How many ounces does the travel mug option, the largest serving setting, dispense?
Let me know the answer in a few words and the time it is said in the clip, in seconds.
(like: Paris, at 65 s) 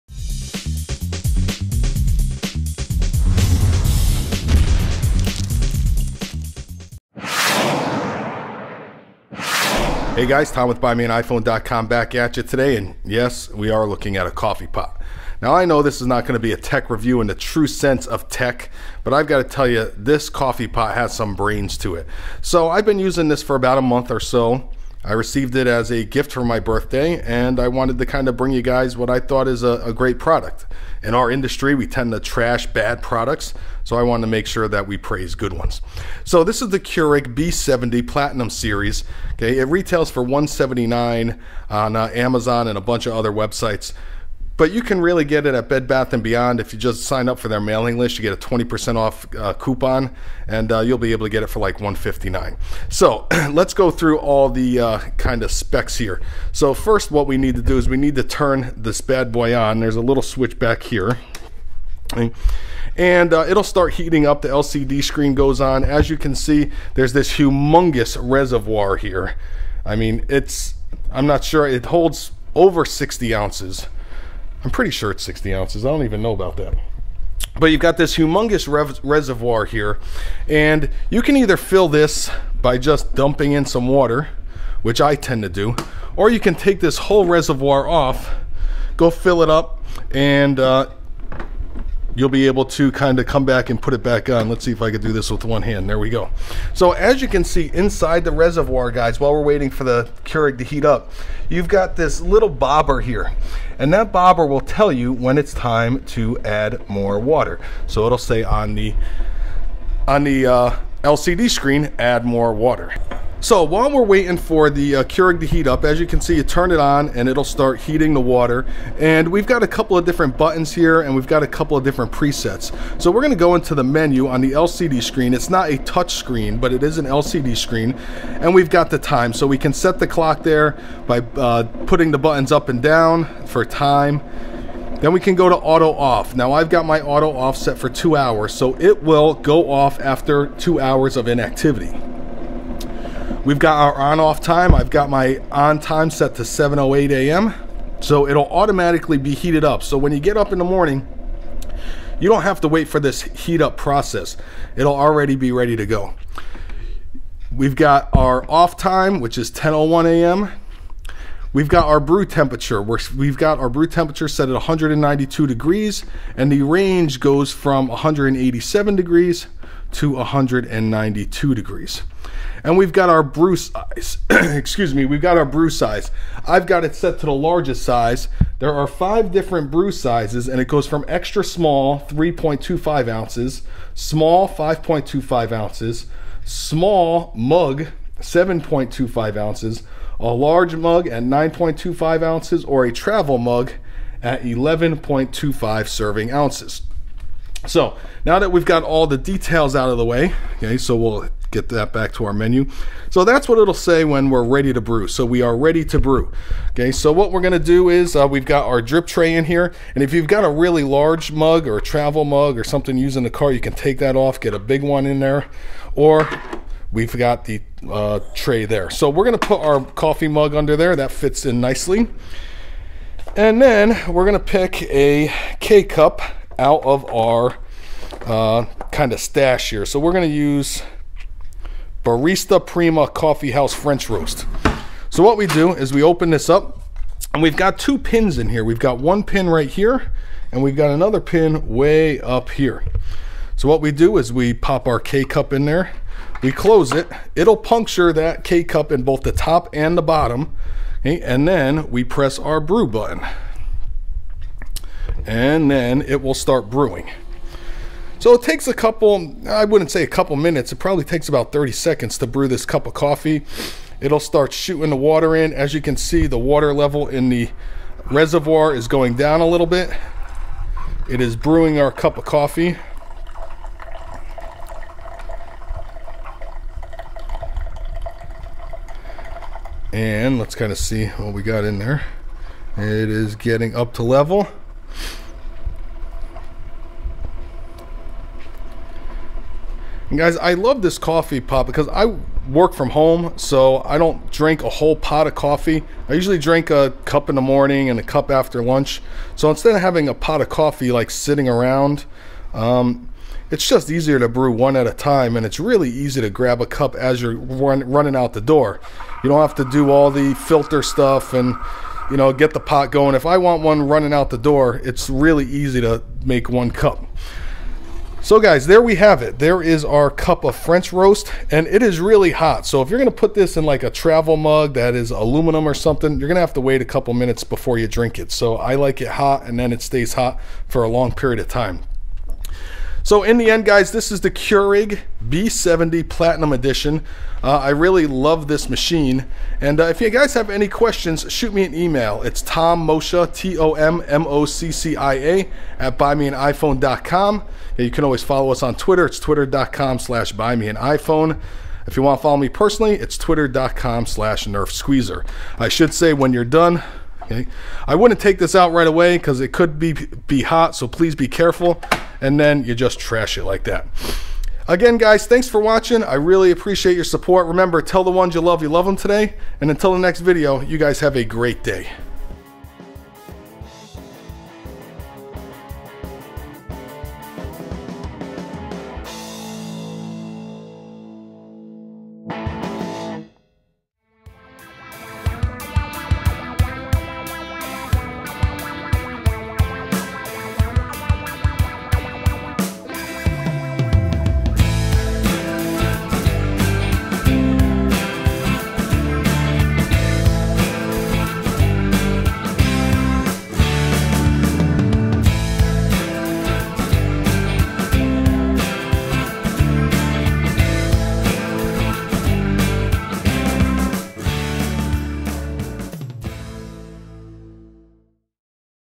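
11.25 ounces, at 194 s.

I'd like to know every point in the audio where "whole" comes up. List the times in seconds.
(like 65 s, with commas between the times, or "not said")
86 s, 294 s.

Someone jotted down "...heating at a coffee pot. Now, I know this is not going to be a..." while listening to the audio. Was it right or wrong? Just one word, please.
wrong.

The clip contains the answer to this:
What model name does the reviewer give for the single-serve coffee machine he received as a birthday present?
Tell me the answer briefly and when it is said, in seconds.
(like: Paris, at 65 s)
Keurig B70 Platinum Series, at 36 s.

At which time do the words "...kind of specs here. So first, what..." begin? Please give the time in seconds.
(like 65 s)
55 s.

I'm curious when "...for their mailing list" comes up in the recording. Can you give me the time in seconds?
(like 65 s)
47 s.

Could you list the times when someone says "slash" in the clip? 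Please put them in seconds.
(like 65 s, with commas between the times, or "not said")
349 s, 354 s.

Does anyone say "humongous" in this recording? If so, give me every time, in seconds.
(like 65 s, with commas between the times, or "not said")
67 s, 78 s.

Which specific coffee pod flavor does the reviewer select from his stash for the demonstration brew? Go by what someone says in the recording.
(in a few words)
Barista Prima Coffee House French Roast.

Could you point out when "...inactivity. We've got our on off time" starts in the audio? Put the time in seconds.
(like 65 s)
141 s.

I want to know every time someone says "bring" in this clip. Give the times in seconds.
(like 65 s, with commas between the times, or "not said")
28 s.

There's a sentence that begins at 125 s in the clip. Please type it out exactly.
It's not a touch screen, but it is an LCD screen.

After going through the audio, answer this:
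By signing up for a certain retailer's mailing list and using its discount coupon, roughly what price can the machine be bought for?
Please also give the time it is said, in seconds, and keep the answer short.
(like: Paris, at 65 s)
$159, at 51 s.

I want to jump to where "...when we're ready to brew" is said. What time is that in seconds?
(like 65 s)
204 s.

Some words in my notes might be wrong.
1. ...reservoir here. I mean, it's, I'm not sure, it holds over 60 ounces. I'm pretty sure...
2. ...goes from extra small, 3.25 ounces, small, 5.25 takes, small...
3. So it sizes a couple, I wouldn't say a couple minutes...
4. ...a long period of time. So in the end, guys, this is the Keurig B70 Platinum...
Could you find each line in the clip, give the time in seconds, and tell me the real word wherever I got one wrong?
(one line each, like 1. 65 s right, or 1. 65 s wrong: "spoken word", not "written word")
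1. 68 s right
2. 180 s wrong: "ounces", not "takes"
3. 258 s wrong: "takes", not "sizes"
4. 330 s right.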